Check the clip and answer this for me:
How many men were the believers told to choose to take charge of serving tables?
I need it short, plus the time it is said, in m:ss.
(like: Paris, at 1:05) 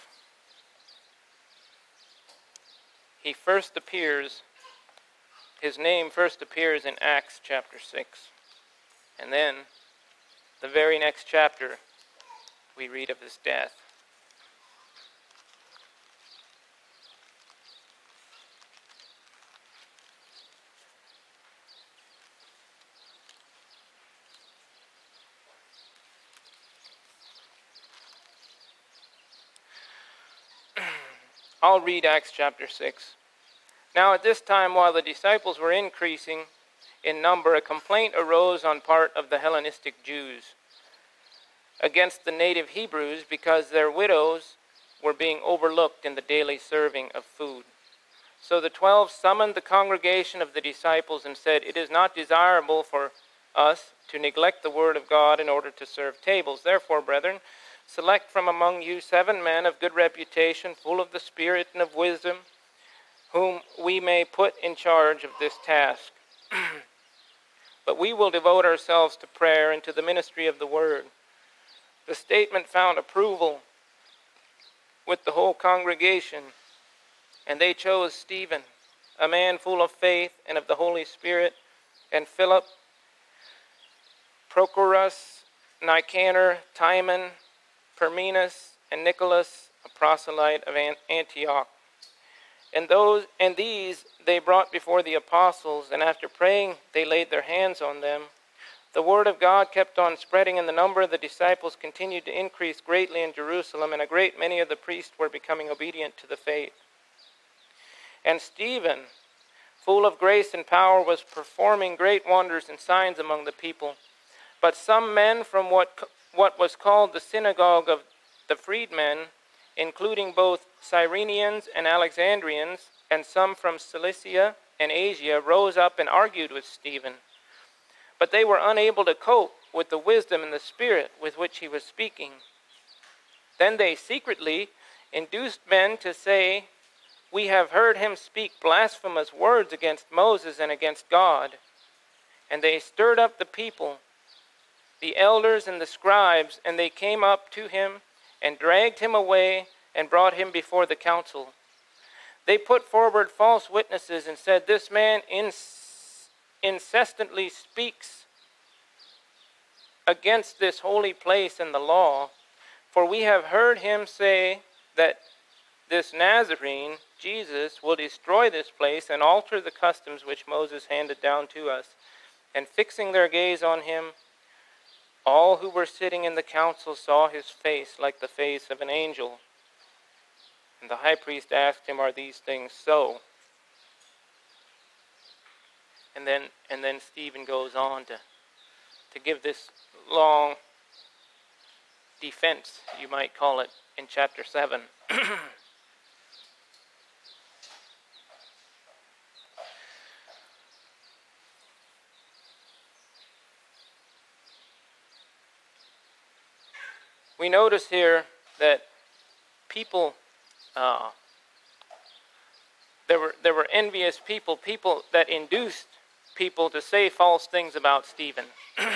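7, at 0:59.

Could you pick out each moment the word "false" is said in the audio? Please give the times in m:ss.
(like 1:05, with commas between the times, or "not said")
2:33, 3:37.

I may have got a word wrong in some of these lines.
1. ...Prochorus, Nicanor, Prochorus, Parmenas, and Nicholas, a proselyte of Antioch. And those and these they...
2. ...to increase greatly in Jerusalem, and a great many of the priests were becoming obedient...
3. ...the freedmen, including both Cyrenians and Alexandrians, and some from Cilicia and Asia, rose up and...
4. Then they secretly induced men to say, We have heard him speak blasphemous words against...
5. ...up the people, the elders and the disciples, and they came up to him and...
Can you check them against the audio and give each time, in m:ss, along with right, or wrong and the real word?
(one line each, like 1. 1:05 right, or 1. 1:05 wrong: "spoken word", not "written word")
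1. 1:24 wrong: "Timon", not "Prochorus"
2. 1:42 right
3. 1:58 right
4. 2:13 right
5. 2:23 wrong: "scribes", not "disciples".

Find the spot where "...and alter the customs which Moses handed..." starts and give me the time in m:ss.
2:49.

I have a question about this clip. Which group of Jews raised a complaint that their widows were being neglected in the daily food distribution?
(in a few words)
Hellenistic Jews.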